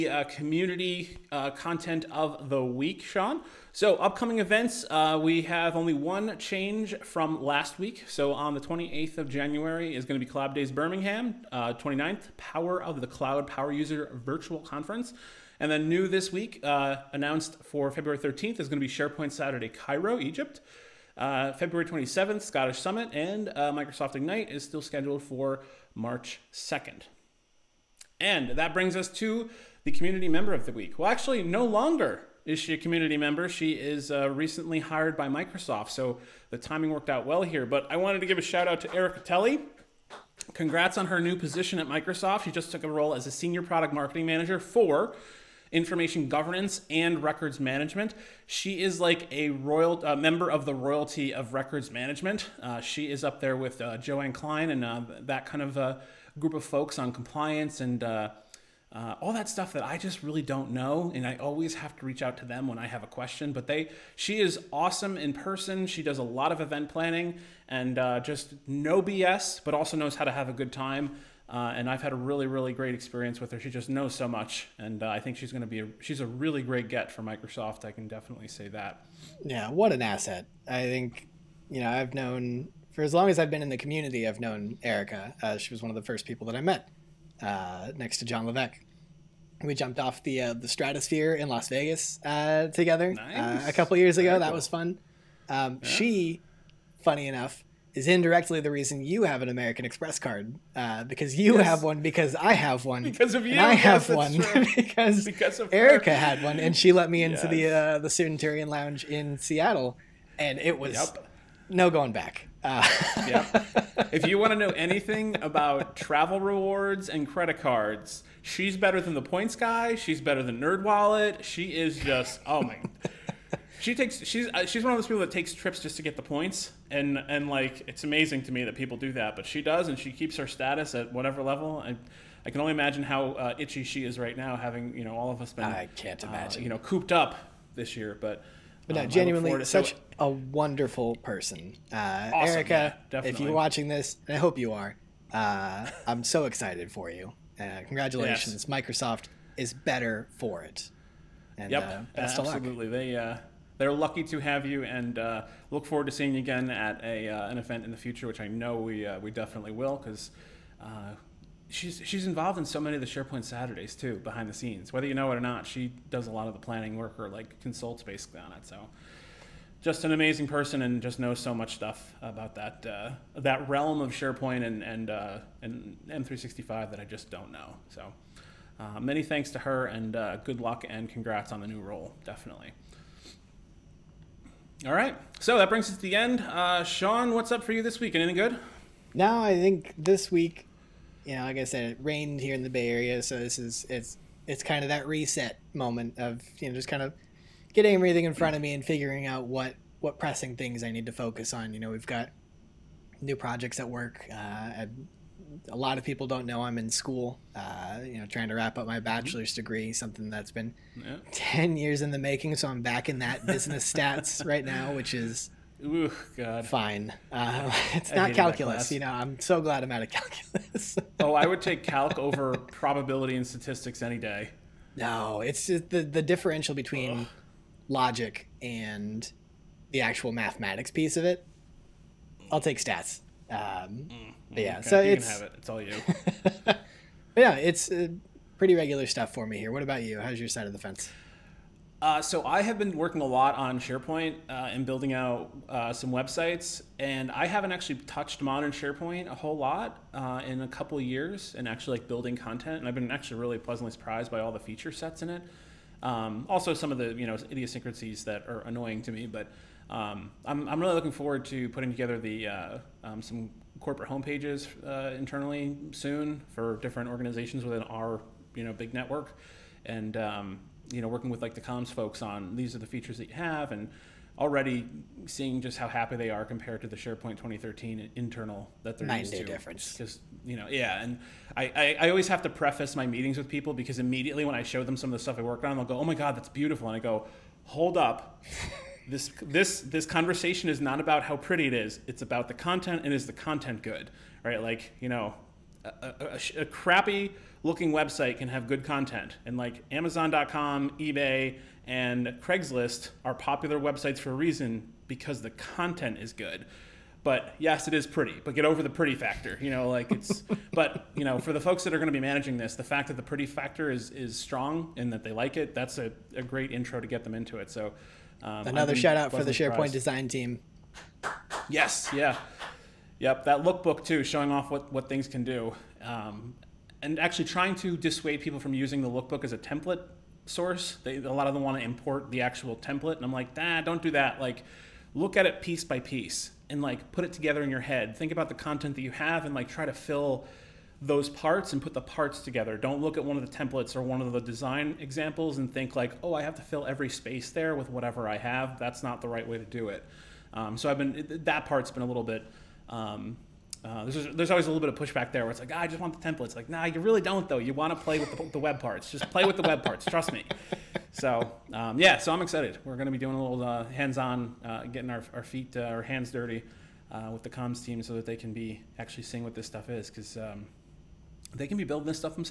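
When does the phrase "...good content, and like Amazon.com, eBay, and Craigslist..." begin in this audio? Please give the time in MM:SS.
04:58.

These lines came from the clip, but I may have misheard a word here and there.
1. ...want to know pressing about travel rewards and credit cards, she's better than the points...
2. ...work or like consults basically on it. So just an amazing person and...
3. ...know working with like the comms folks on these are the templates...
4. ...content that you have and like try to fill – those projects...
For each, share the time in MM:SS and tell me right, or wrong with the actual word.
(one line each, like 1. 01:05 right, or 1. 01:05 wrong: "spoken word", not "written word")
1. 01:54 wrong: "anything", not "pressing"
2. 02:46 right
3. 04:31 wrong: "features", not "templates"
4. 05:38 wrong: "parts", not "projects".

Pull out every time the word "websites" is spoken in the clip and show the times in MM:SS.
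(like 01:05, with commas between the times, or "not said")
04:06, 04:57, 05:03.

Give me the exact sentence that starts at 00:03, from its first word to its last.
So, upcoming events, uh, we have only one change from last week.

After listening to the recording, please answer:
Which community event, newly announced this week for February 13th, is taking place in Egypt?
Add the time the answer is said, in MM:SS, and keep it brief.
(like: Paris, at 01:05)
SharePoint Saturday Cairo, at 00:18.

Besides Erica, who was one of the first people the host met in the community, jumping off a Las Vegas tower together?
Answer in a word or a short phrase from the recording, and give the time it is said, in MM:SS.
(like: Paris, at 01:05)
John Levesque, at 01:28.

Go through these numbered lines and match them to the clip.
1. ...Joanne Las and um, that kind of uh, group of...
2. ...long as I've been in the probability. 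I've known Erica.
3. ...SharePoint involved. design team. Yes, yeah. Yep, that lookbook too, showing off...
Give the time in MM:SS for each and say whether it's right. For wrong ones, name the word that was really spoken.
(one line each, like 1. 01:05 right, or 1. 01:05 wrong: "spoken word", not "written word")
1. 00:53 wrong: "Klein", not "Las"
2. 01:23 wrong: "community", not "probability"
3. 05:19 wrong: "surprised", not "involved".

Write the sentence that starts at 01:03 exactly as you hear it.
But they, she is awesome in person.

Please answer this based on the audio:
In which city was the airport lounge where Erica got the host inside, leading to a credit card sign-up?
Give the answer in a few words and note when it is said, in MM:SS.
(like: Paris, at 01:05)
Seattle, at 01:49.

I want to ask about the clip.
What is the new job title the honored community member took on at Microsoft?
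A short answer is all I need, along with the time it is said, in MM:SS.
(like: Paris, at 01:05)
Senior product marketing manager, at 00:43.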